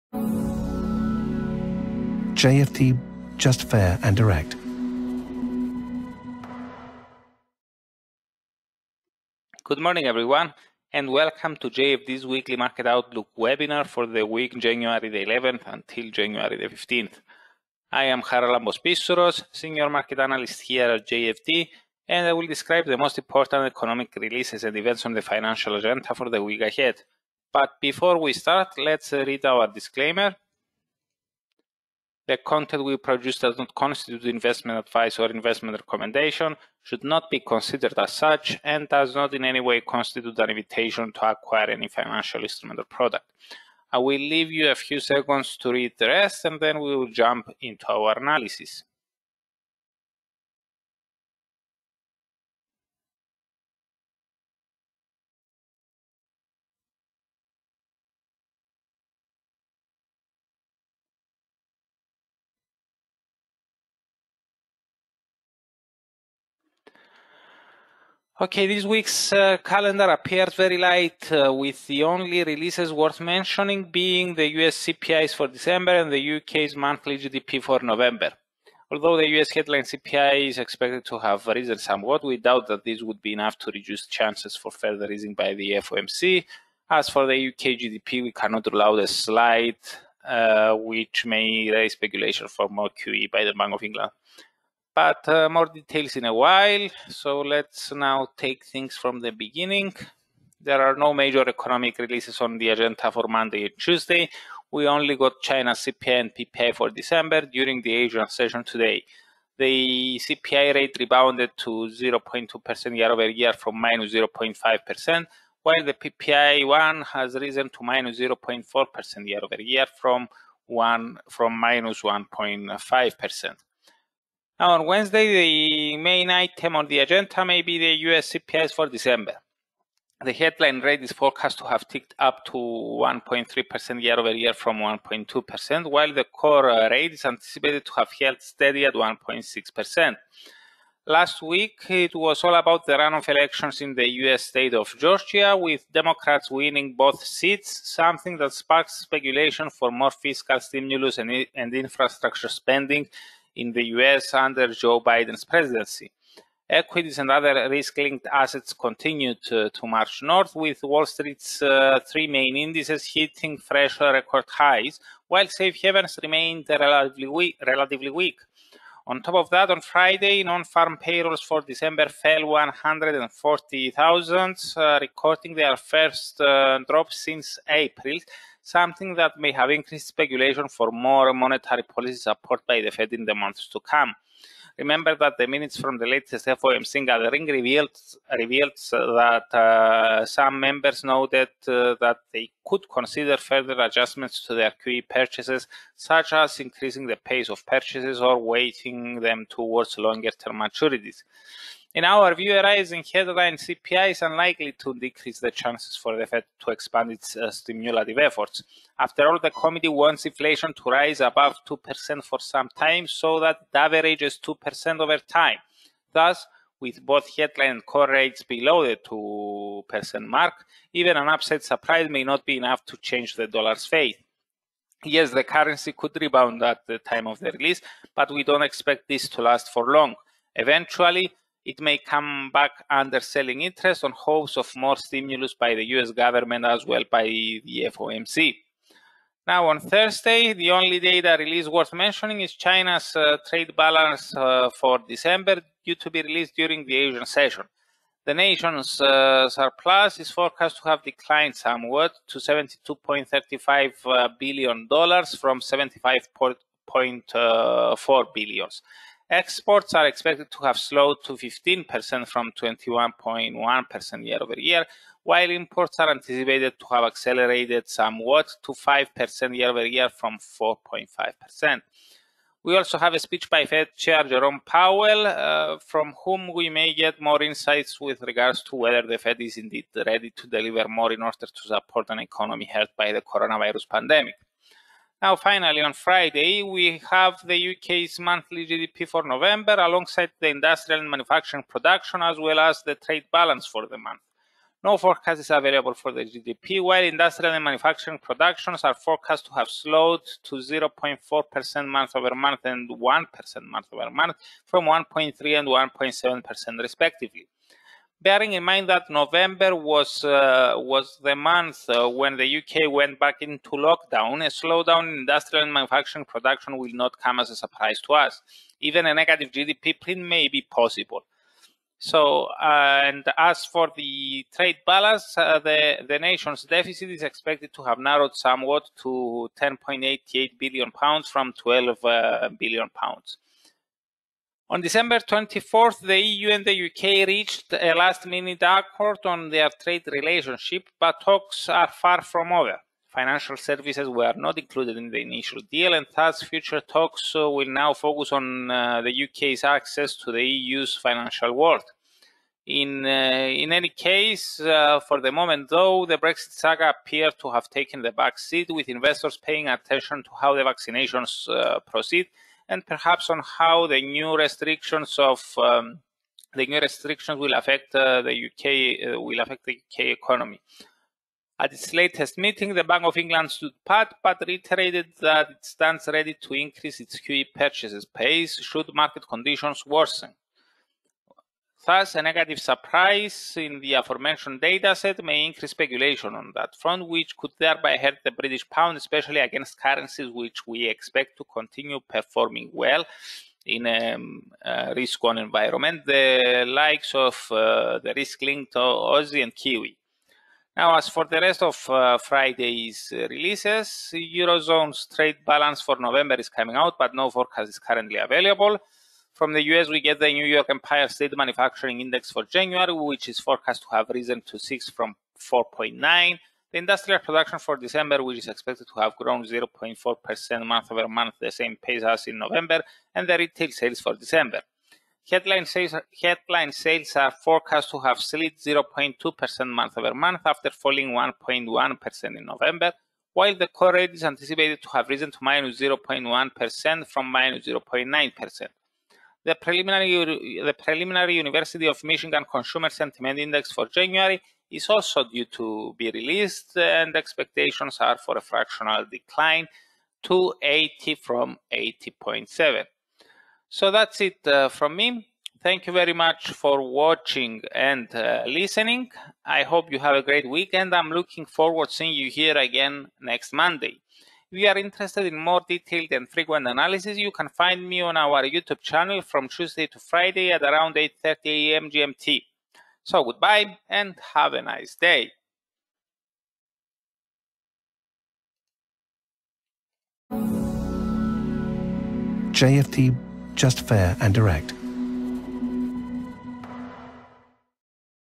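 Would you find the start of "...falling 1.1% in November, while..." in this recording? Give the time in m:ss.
7:10.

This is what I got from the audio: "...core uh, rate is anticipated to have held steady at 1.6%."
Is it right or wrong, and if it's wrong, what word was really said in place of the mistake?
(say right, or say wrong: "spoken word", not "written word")
right.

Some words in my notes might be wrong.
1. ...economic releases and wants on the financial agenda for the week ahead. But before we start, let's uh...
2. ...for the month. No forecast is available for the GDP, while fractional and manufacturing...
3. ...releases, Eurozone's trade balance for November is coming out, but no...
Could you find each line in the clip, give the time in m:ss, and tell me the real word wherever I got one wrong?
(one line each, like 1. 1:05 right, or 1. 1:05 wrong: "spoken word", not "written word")
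1. 0:23 wrong: "events", not "wants"
2. 4:53 wrong: "industrial", not "fractional"
3. 6:43 right.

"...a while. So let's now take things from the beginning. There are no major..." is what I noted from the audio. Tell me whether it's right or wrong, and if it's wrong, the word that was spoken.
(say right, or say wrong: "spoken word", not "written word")
right.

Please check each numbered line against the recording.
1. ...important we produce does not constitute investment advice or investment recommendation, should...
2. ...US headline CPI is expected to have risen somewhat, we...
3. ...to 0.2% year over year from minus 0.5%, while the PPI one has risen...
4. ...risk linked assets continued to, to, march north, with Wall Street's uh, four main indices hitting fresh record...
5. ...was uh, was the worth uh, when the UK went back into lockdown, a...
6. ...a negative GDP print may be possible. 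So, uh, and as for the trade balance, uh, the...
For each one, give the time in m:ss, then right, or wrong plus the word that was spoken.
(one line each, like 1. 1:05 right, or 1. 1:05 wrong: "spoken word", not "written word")
1. 0:32 wrong: "content", not "important"
2. 1:19 right
3. 1:51 right
4. 2:37 wrong: "three", not "four"
5. 5:09 wrong: "month", not "worth"
6. 5:19 right.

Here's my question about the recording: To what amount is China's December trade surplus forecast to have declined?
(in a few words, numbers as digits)
72.35 billion dollars.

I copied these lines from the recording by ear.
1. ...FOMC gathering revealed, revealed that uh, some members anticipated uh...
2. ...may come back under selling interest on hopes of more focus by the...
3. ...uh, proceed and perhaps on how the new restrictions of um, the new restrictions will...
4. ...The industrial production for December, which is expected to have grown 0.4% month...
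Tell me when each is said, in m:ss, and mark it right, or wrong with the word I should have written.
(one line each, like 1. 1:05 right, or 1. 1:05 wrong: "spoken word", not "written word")
1. 3:06 wrong: "noted", not "anticipated"
2. 3:51 wrong: "stimulus", not "focus"
3. 6:01 right
4. 6:56 right.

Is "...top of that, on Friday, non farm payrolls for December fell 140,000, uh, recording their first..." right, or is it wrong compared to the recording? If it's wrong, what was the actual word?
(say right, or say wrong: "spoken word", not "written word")
right.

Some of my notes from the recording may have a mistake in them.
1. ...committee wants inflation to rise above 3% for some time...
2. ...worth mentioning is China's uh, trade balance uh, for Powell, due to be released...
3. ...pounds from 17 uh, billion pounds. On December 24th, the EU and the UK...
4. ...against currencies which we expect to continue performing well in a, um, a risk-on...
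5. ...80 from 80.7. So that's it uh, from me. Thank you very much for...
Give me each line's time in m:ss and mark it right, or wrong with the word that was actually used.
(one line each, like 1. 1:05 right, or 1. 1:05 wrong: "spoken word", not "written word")
1. 3:29 wrong: "2", not "3"
2. 4:01 wrong: "December", not "Powell"
3. 5:30 wrong: "12", not "17"
4. 6:29 right
5. 7:30 right.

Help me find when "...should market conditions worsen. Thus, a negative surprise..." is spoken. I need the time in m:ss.
6:18.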